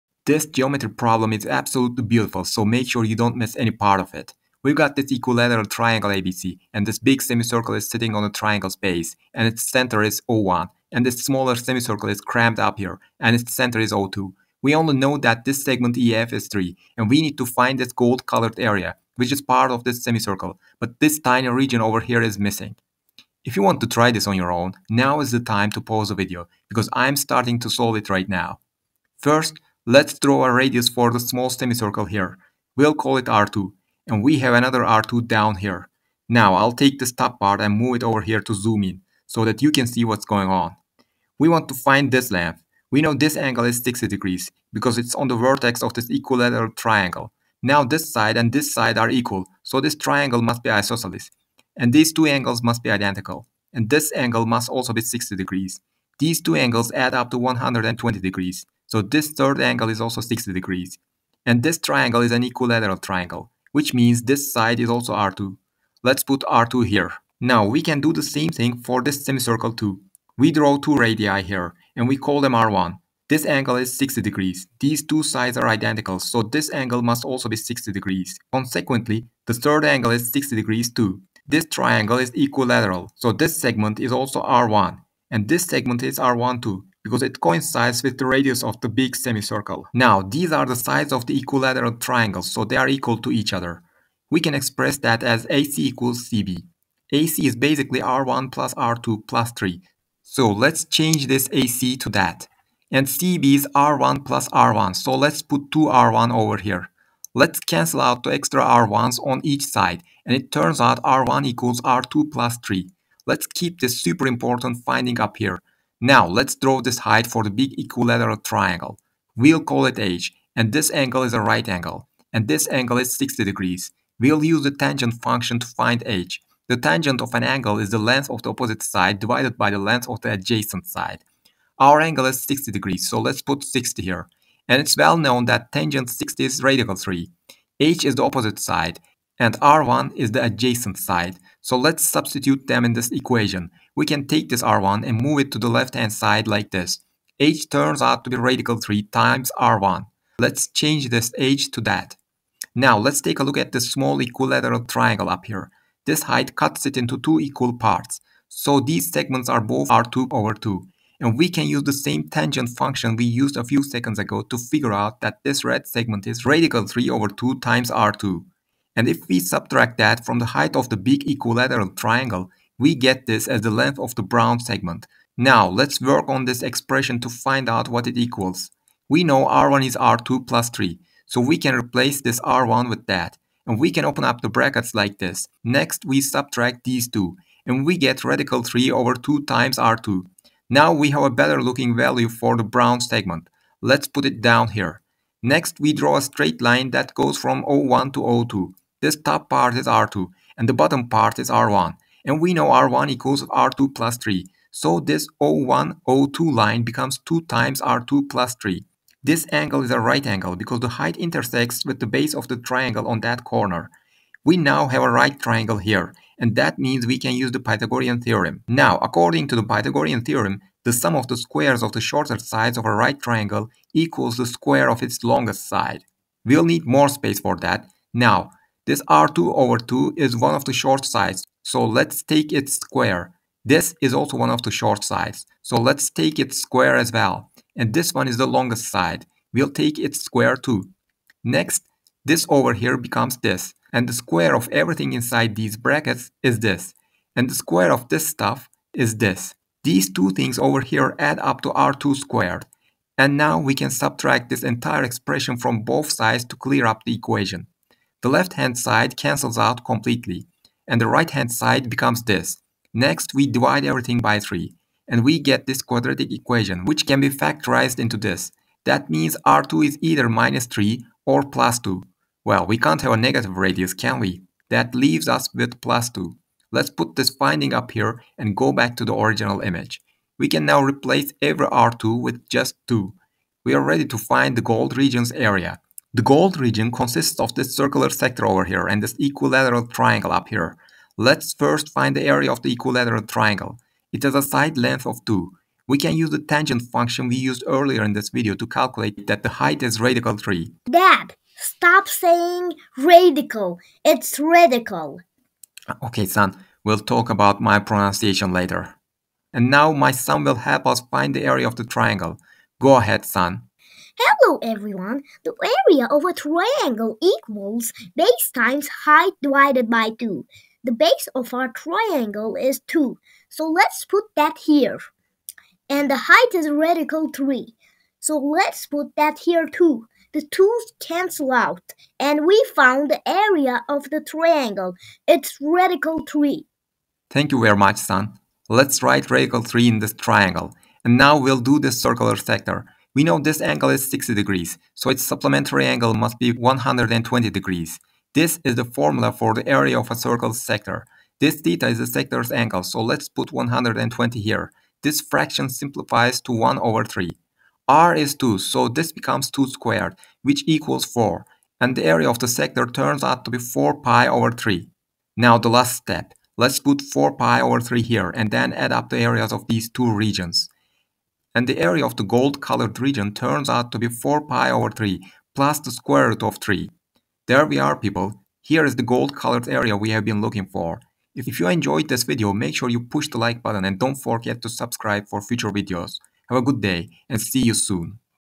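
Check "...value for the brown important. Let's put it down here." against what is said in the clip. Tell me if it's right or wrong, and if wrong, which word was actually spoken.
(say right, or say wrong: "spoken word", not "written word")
wrong: "segment", not "important".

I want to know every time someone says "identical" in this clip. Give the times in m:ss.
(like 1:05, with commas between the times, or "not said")
0:52, 1:15.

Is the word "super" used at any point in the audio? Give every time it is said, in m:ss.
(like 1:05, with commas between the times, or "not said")
1:54.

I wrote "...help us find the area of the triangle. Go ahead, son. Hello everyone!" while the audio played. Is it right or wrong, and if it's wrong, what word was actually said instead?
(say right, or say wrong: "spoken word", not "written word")
right.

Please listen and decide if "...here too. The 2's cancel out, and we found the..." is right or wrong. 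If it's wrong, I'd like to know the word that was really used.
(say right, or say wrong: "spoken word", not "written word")
right.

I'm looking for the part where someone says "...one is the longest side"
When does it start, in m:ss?
3:58.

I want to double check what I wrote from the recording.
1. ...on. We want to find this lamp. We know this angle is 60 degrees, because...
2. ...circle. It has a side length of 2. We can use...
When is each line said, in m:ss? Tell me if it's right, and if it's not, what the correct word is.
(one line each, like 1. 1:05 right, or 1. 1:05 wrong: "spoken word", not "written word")
1. 0:40 right
2. 4:53 wrong: "triangle", not "circle".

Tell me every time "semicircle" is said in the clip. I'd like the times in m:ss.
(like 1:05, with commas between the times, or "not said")
0:07, 0:11, 0:20, 0:31, 1:09, 1:29.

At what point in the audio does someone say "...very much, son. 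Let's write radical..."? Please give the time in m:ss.
5:37.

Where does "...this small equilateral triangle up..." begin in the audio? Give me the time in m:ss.
2:33.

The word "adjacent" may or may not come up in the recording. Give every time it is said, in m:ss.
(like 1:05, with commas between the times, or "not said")
2:10, 2:20.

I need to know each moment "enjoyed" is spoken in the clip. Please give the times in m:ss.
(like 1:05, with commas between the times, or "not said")
6:21.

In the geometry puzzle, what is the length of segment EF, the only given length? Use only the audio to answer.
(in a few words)
3.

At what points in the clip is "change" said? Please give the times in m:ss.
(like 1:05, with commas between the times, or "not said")
1:40, 2:30.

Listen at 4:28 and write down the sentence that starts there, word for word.
That means R2 is either minus 3 or plus 2.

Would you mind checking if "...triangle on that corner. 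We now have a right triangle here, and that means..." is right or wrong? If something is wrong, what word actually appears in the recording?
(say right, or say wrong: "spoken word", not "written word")
right.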